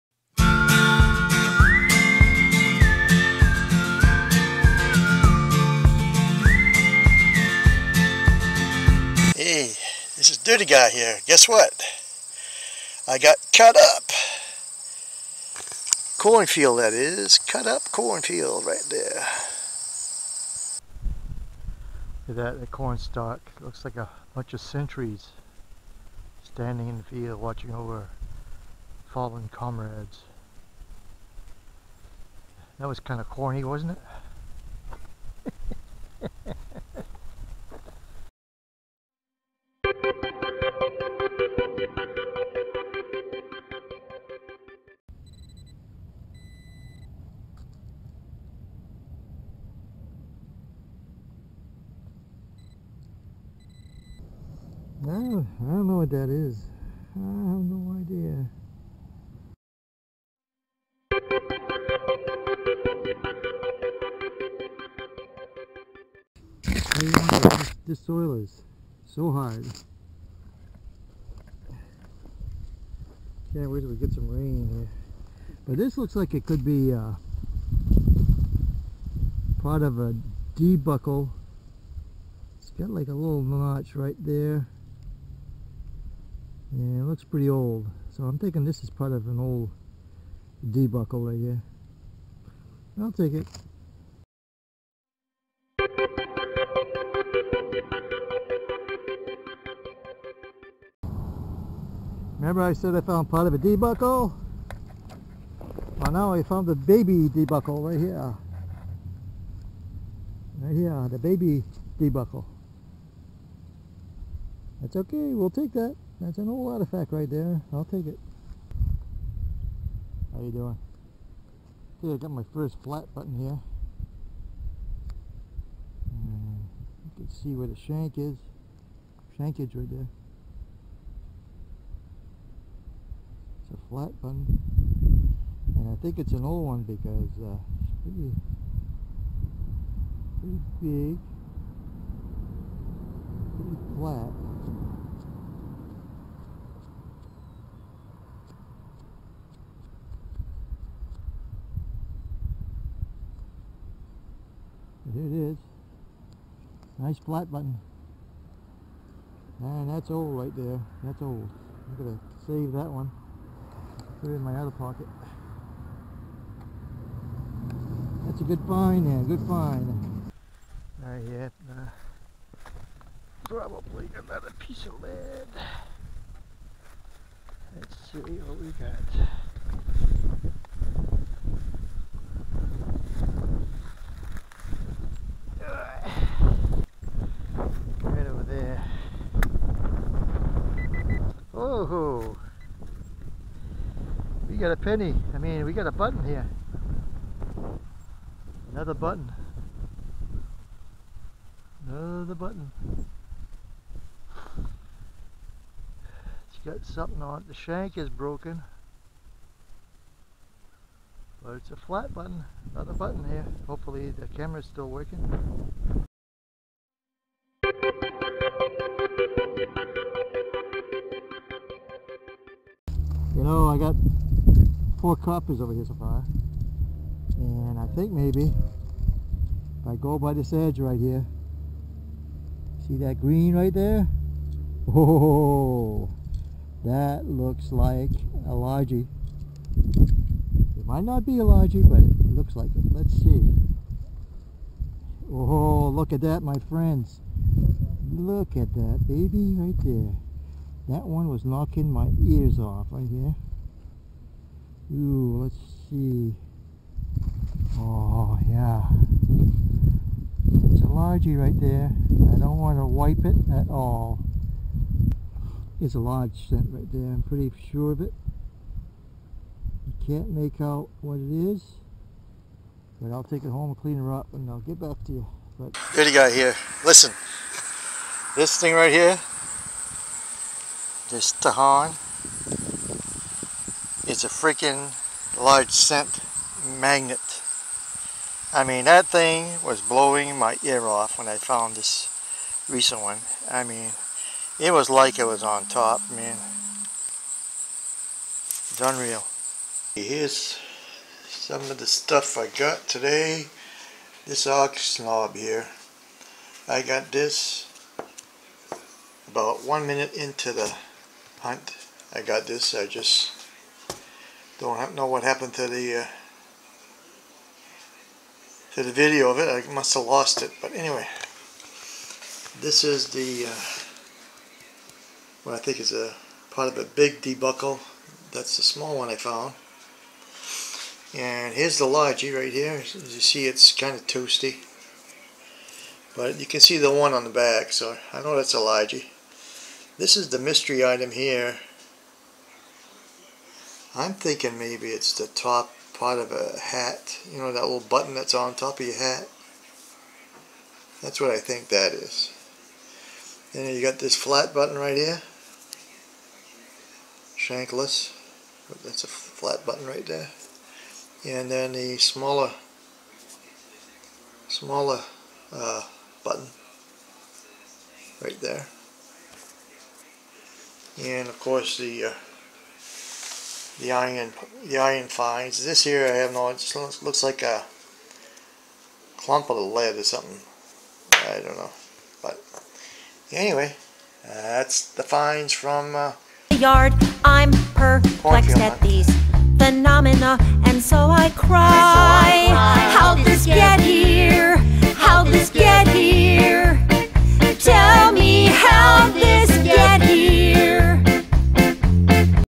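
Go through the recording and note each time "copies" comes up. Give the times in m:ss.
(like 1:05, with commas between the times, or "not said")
3:45.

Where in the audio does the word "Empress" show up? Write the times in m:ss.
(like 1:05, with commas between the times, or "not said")
not said.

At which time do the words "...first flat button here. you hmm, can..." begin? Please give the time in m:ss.
2:02.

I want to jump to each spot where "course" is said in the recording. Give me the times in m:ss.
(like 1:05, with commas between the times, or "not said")
6:11.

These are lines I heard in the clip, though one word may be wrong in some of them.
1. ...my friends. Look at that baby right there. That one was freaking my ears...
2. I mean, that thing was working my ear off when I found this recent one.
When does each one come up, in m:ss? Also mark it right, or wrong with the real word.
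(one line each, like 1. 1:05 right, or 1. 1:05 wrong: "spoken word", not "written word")
1. 4:06 wrong: "knocking", not "freaking"
2. 4:48 wrong: "blowing", not "working".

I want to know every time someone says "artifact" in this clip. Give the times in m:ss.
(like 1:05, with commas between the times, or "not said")
1:56.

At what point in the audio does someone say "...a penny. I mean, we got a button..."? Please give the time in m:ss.
3:14.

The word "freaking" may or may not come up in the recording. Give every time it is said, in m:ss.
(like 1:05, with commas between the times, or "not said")
4:44.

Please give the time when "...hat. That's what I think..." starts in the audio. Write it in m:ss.
5:48.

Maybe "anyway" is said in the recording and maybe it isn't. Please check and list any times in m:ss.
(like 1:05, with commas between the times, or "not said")
5:20, 6:23.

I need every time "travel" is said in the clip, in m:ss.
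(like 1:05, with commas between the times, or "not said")
not said.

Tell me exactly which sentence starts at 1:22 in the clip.
It's got like a little notch right there.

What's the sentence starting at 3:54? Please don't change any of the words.
Oh, that looks like a largie.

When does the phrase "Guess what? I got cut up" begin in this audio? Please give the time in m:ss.
0:11.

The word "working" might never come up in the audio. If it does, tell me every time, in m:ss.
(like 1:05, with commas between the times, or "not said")
3:34.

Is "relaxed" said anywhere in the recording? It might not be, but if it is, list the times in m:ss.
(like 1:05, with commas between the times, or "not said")
not said.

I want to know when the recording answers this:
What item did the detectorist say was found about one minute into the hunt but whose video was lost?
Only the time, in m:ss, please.
5:04.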